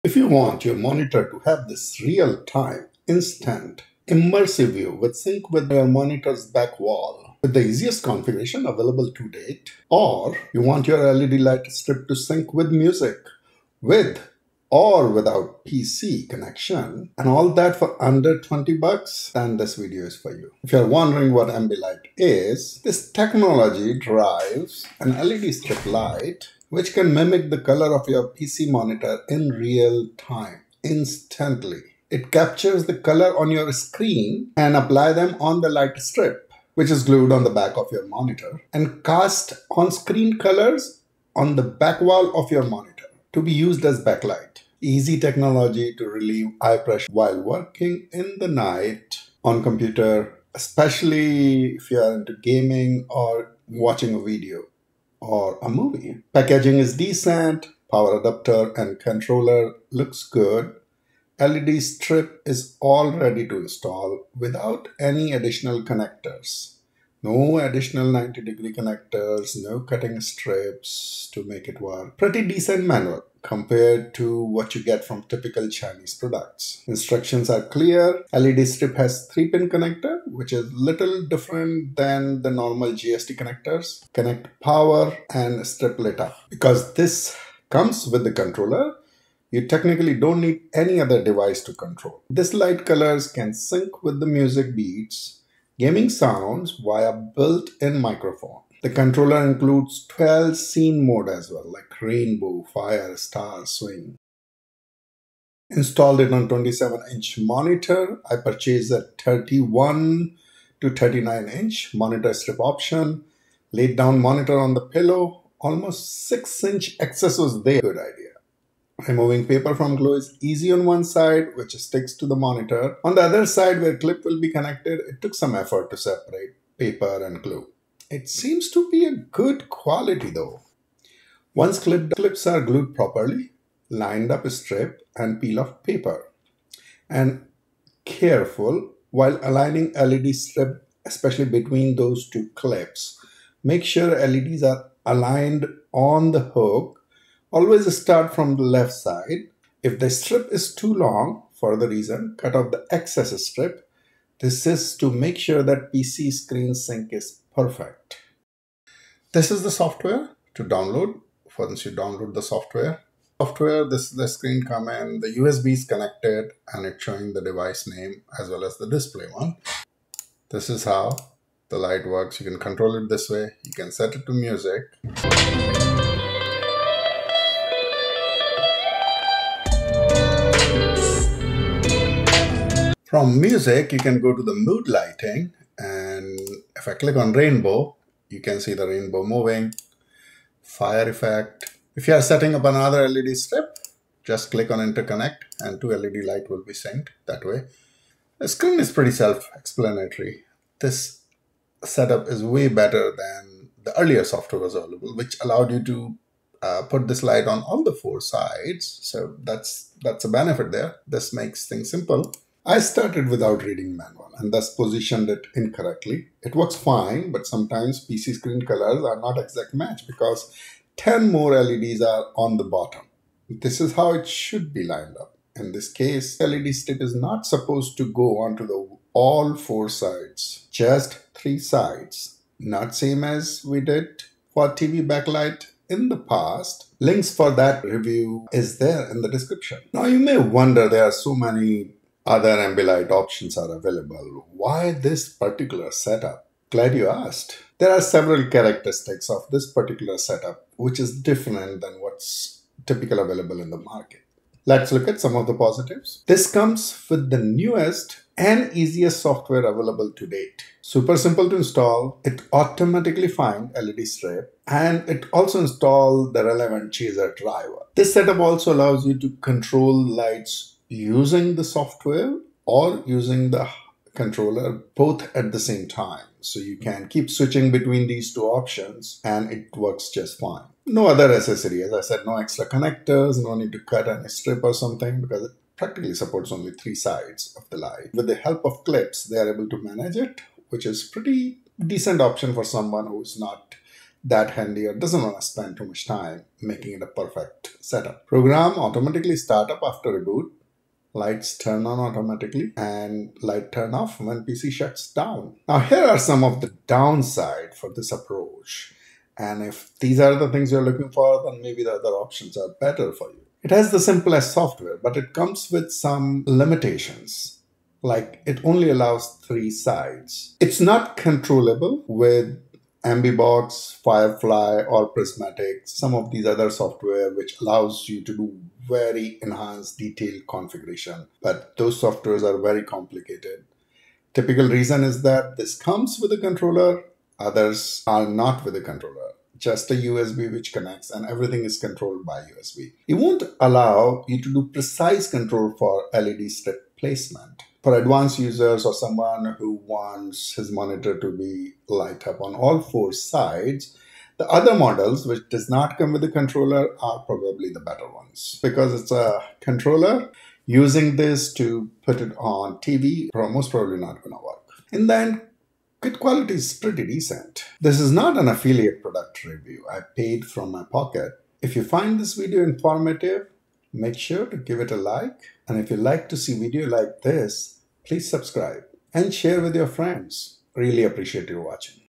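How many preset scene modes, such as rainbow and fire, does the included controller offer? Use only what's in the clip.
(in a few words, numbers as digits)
12.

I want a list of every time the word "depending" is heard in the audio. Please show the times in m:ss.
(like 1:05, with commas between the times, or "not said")
not said.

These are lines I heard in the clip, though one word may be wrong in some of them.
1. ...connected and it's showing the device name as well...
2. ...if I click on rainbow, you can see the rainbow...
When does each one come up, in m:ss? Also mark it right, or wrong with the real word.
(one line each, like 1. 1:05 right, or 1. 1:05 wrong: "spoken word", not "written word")
1. 2:45 right
2. 3:06 right.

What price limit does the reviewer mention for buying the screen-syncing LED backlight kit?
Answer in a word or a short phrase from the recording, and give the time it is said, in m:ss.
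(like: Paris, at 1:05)
under $20, at 0:18.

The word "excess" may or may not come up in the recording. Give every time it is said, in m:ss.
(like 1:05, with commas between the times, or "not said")
1:56, 2:32.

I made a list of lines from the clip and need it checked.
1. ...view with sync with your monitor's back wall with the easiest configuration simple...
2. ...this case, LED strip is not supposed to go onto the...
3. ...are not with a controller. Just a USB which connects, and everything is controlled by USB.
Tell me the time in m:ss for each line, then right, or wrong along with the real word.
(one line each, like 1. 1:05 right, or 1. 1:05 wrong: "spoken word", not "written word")
1. 0:04 wrong: "available", not "simple"
2. 3:45 right
3. 5:38 right.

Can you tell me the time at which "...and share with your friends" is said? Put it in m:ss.
6:19.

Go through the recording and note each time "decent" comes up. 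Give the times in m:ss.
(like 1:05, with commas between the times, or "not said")
0:56, 1:12, 4:51, 6:07.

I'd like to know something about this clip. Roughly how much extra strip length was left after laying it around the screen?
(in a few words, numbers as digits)
6 inch.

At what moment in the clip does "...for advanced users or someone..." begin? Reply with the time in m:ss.
5:47.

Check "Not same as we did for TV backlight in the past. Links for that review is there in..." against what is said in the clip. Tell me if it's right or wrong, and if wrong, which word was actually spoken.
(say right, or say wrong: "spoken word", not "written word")
right.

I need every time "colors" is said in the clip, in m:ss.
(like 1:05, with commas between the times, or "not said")
0:27, 0:32, 0:40, 1:32, 3:38.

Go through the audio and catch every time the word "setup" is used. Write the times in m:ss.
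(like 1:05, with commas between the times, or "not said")
3:21, 4:05, 4:10, 4:28, 4:57.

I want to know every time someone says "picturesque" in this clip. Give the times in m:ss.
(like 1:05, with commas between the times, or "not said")
not said.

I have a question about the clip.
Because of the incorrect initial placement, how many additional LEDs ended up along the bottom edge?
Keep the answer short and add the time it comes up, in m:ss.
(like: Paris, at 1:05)
10, at 3:40.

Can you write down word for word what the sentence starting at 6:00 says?
Using this to put it on TV, most probably not going to work.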